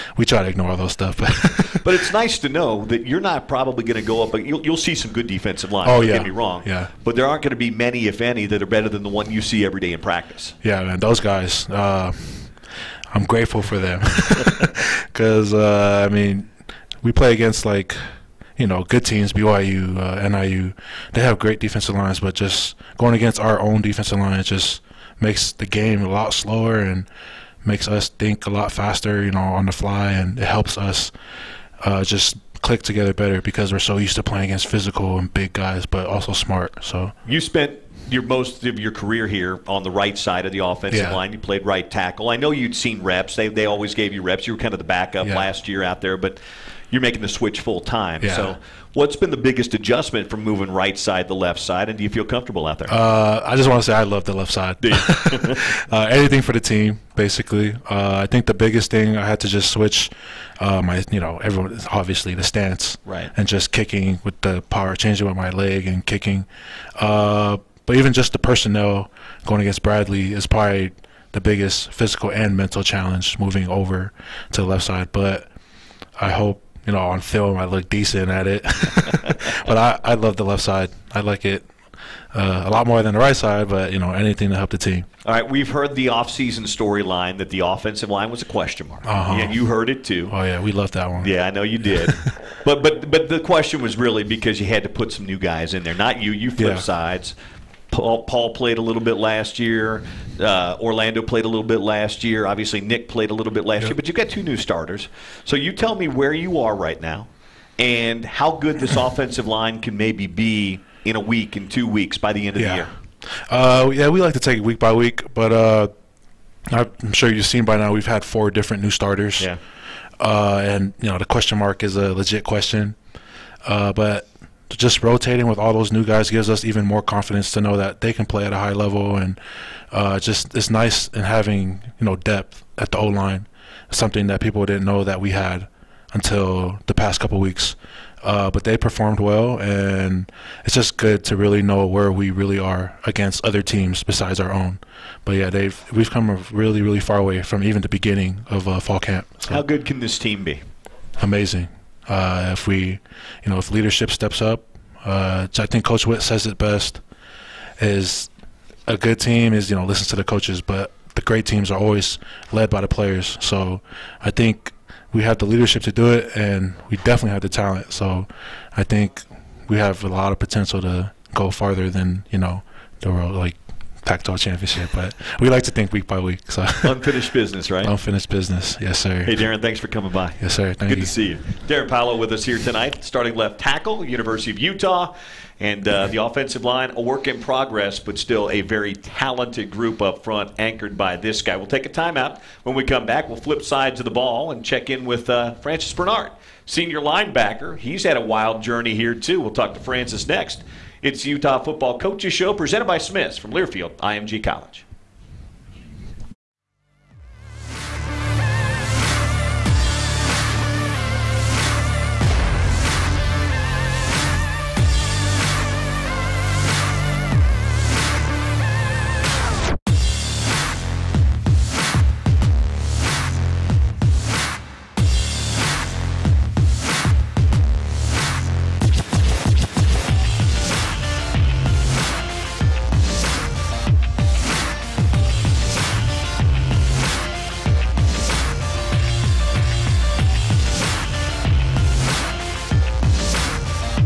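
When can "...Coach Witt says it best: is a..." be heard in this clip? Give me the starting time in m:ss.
2:35.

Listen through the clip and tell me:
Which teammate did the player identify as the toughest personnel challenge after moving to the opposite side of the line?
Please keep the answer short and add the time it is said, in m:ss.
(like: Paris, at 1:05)
Bradley, at 1:09.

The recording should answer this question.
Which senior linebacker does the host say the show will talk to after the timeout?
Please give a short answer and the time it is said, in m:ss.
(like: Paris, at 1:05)
Francis Bernard, at 3:15.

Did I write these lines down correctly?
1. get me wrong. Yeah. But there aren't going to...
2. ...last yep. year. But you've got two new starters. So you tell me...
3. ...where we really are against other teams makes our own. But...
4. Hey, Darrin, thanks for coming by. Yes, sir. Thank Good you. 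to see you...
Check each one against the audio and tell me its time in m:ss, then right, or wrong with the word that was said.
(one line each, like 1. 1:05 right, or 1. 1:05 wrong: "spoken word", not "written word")
1. 0:06 right
2. 1:43 right
3. 2:21 wrong: "besides", not "makes"
4. 2:59 right.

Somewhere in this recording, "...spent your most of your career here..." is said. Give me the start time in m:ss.
0:37.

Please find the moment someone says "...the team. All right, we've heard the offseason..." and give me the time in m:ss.
1:24.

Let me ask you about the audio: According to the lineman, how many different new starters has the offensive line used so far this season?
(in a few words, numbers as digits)
4.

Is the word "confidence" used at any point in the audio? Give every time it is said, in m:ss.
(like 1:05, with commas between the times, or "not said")
2:07.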